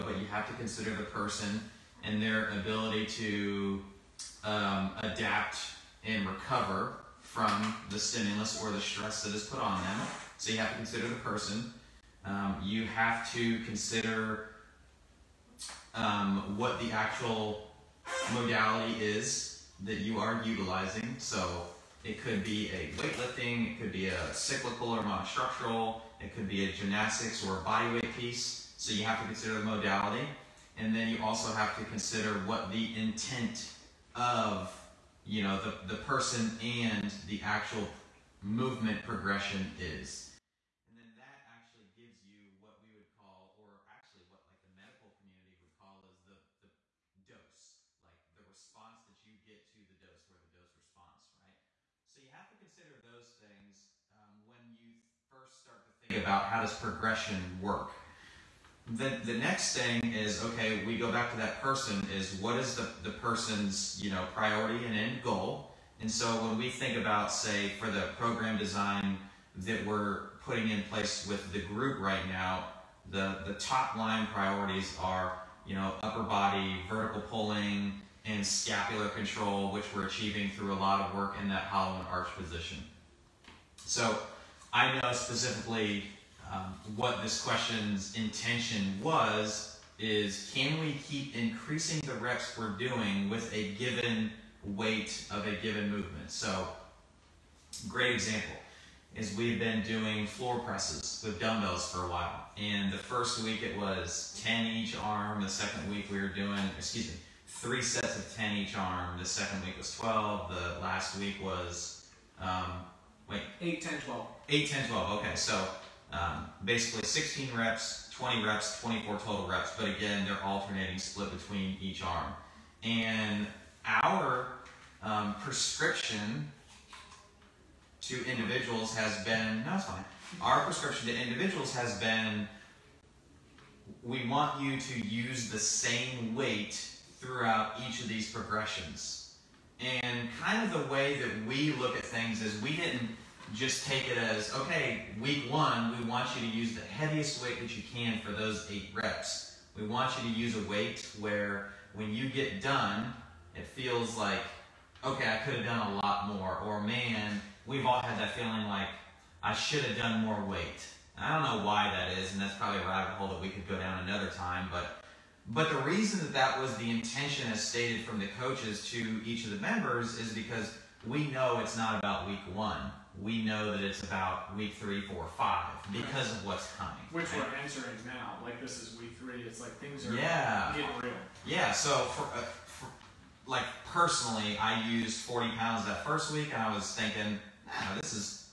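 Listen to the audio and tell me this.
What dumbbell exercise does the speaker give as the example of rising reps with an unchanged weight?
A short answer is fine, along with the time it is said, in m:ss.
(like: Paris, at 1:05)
floor presses, at 1:40.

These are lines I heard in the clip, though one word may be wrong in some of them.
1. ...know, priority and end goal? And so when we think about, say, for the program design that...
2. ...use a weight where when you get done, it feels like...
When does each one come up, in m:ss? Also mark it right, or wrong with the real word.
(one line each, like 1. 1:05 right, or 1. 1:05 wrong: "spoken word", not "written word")
1. 1:04 right
2. 2:30 right.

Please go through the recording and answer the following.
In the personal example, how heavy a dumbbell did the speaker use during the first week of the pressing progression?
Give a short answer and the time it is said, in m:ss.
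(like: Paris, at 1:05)
40 pounds, at 3:05.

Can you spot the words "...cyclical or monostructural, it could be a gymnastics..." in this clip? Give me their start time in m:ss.
0:24.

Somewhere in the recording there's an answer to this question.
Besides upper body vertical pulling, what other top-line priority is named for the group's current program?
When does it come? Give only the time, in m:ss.
1:18.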